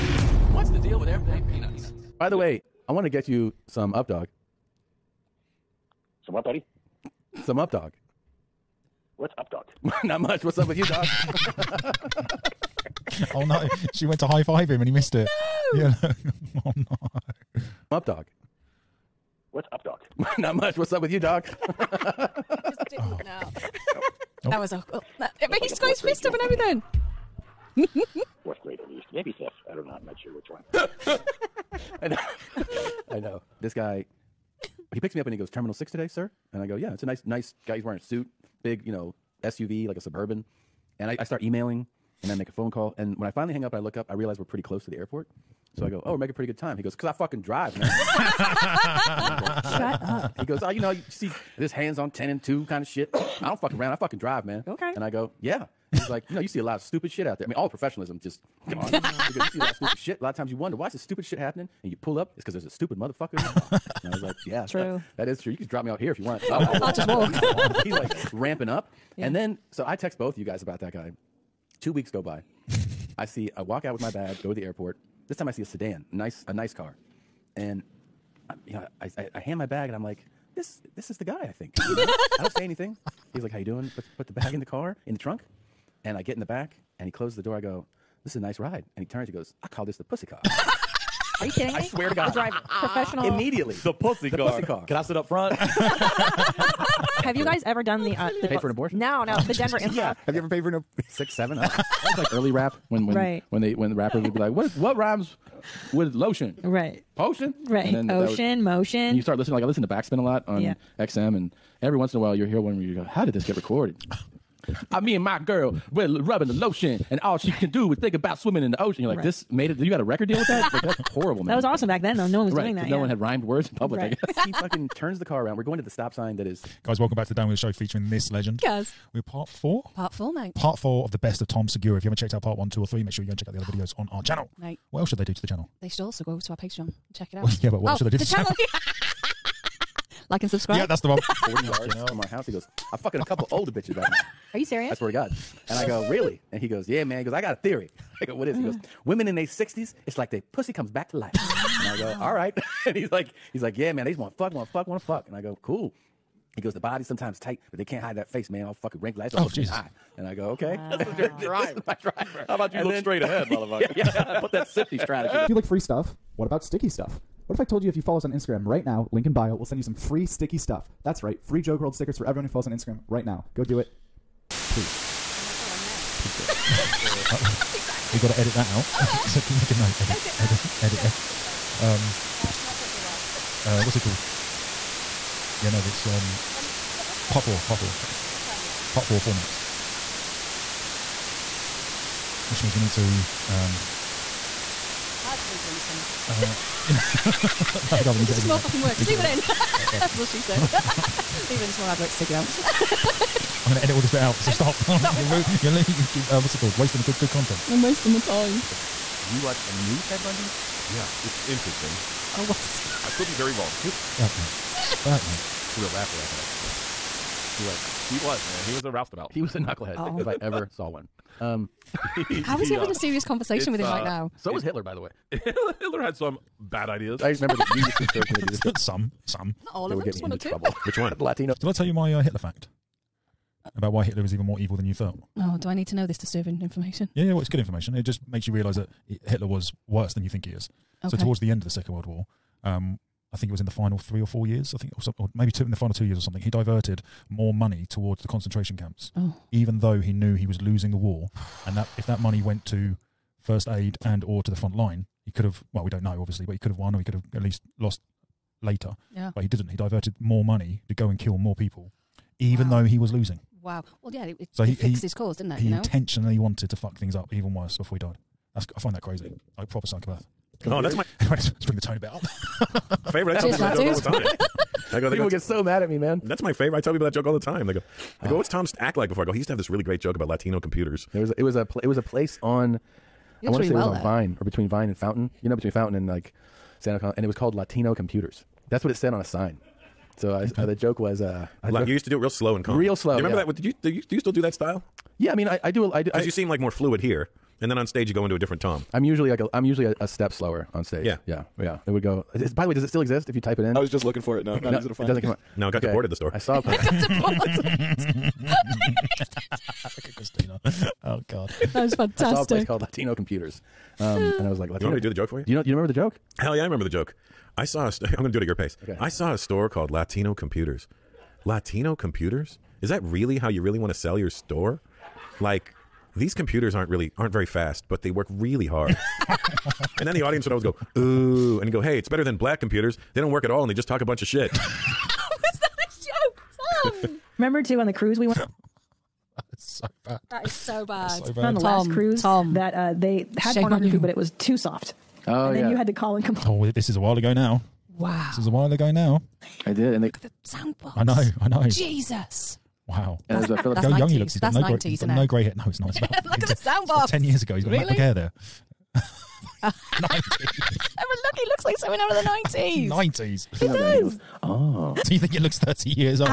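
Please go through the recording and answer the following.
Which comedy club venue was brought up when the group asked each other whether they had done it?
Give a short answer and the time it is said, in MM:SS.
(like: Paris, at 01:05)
Denver Improv, at 01:39.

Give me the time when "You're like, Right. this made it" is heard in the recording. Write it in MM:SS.
01:59.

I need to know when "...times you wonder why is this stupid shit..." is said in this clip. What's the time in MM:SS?
01:00.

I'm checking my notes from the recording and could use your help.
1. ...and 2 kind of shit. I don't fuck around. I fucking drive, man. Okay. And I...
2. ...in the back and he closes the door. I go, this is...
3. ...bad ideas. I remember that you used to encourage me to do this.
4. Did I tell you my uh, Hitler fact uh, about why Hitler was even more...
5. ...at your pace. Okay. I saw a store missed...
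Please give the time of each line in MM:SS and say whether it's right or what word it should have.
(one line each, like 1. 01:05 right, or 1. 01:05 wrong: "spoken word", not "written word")
1. 00:52 right
2. 01:26 right
3. 03:46 right
4. 03:51 right
5. 05:18 wrong: "called", not "missed".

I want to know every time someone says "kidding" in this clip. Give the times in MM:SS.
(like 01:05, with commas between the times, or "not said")
01:31.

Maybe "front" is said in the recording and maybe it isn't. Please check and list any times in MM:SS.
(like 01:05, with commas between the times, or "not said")
01:35, 04:14.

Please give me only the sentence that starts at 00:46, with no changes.
He goes, because I fucking drive, man.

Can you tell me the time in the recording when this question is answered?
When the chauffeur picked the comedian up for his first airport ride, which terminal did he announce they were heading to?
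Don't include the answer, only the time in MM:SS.
00:35.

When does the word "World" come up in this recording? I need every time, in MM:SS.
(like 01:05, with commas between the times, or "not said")
02:51, 04:01.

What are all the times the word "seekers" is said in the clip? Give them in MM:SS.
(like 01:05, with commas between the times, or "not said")
not said.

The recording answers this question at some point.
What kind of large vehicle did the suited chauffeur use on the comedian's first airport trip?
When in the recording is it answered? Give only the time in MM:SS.
00:39.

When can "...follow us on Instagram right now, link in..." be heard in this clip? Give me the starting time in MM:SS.
02:48.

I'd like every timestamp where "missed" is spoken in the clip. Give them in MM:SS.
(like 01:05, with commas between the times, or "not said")
00:14.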